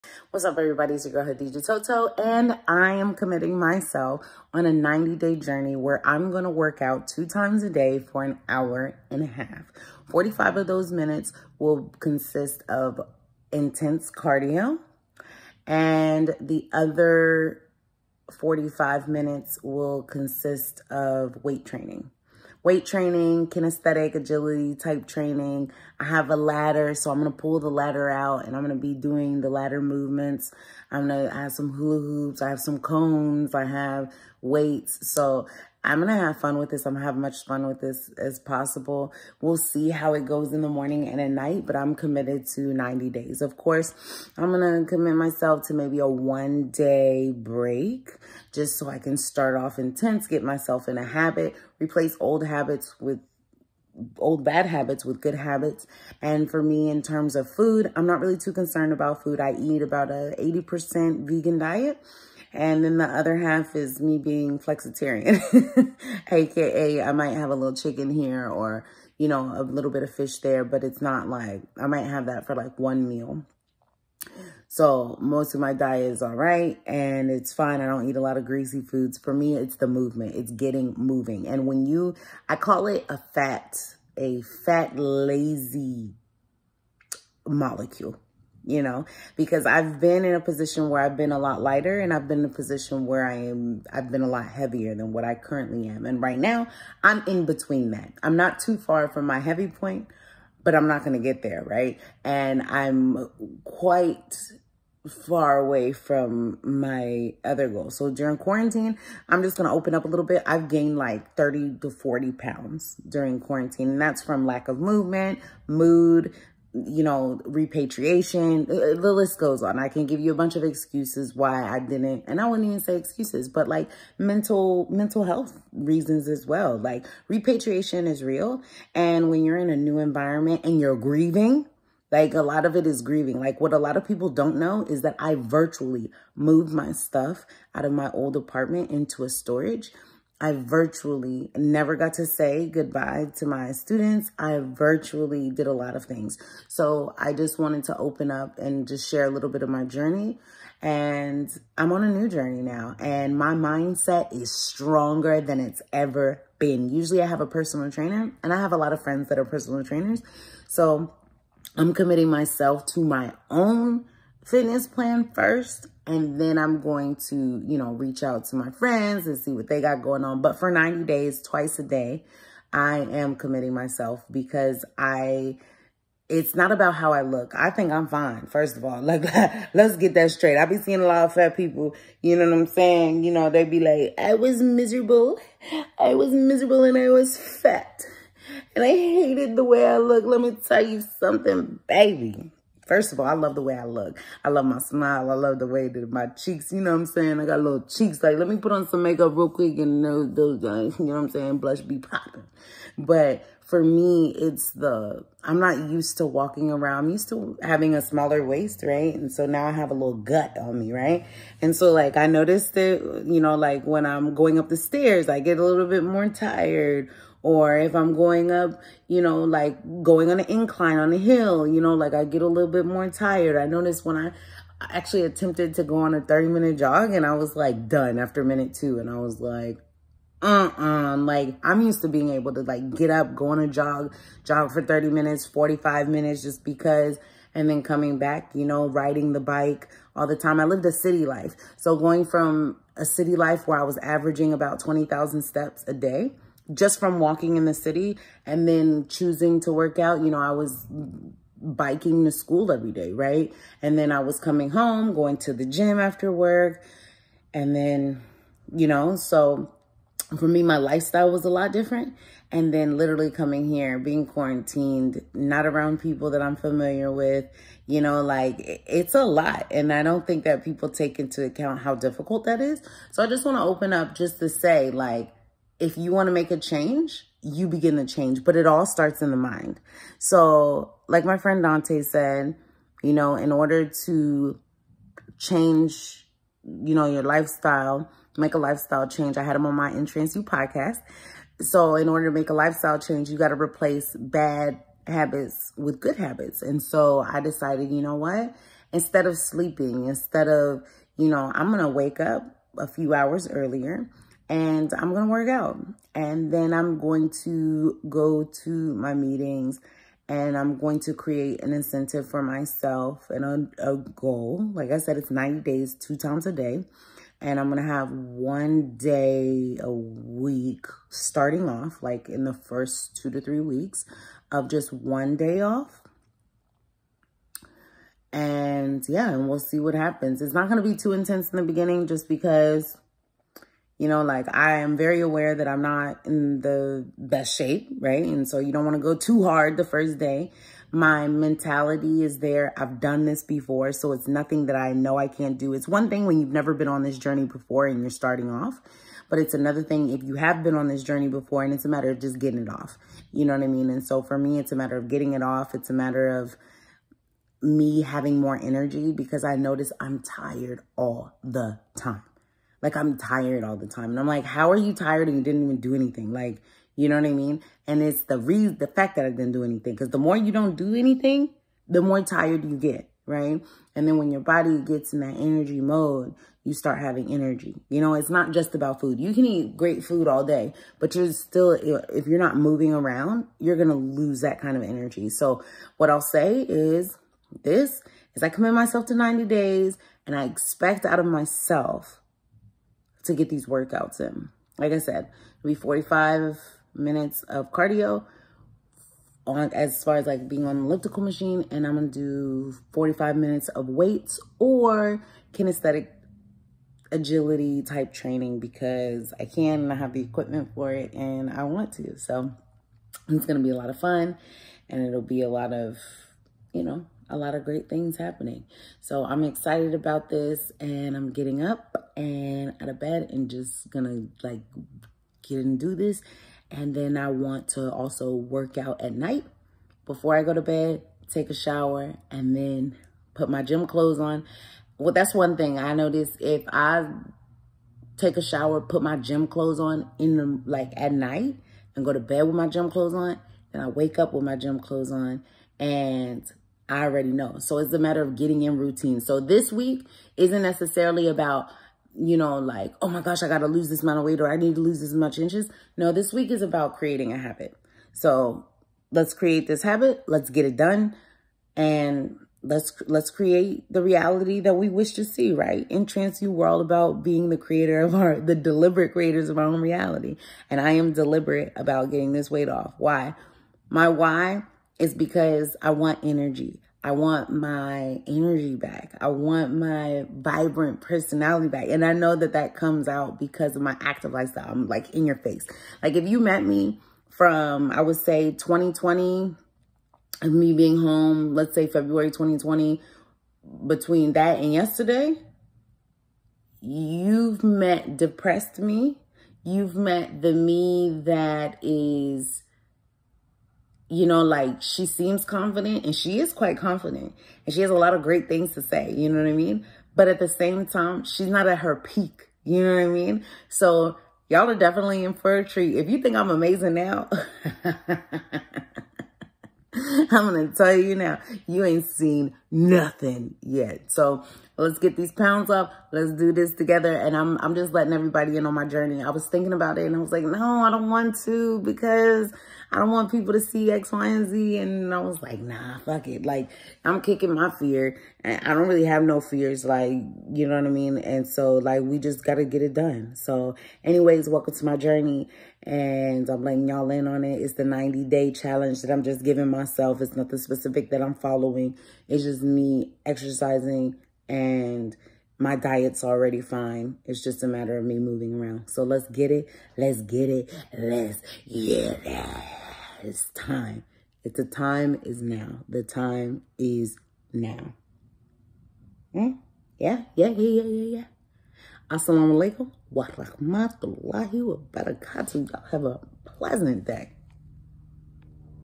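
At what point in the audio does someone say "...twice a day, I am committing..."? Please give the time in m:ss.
2:51.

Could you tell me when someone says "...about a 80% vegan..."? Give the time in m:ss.
0:59.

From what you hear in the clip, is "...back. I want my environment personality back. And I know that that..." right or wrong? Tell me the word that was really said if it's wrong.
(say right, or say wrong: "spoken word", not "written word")
wrong: "vibrant", not "environment".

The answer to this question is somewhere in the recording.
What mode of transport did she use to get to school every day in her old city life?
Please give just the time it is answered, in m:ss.
4:11.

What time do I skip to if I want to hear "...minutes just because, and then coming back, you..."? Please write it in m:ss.
3:56.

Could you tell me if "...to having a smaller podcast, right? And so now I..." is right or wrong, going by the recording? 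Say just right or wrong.
wrong.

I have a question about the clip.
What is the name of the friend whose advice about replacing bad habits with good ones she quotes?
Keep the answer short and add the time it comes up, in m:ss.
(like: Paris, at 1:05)
Dante, at 4:41.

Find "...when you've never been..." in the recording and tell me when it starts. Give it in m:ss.
5:46.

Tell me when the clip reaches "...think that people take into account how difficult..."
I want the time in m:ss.
4:30.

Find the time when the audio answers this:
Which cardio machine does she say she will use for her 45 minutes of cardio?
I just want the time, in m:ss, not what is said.
6:40.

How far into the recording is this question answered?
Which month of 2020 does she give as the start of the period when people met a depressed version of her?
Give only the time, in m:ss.
8:11.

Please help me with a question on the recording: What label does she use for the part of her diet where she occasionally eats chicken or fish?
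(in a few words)
flexitarian.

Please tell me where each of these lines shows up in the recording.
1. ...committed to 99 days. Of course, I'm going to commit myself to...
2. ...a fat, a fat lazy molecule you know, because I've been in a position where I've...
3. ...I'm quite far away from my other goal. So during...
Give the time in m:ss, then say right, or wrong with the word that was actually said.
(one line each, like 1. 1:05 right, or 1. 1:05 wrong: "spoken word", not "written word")
1. 0:41 wrong: "90", not "99"
2. 1:23 right
3. 1:42 right.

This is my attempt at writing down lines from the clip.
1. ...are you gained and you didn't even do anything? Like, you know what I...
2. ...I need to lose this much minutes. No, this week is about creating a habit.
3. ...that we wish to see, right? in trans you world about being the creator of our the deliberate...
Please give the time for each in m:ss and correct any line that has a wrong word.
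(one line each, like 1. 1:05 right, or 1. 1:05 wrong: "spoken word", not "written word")
1. 6:04 wrong: "tired", not "gained"
2. 7:34 wrong: "inches", not "minutes"
3. 7:44 right.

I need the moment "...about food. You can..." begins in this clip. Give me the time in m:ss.
6:18.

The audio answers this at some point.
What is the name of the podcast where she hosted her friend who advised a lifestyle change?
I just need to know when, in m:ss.
4:49.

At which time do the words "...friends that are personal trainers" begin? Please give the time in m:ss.
2:39.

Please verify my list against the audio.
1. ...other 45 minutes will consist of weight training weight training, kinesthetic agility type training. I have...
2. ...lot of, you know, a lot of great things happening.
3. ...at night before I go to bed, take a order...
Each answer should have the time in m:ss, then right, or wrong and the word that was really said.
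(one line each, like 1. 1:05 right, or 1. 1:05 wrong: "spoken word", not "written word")
1. 0:16 right
2. 6:55 right
3. 7:09 wrong: "shower", not "order".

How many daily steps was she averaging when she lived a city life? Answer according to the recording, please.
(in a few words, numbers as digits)
20,000.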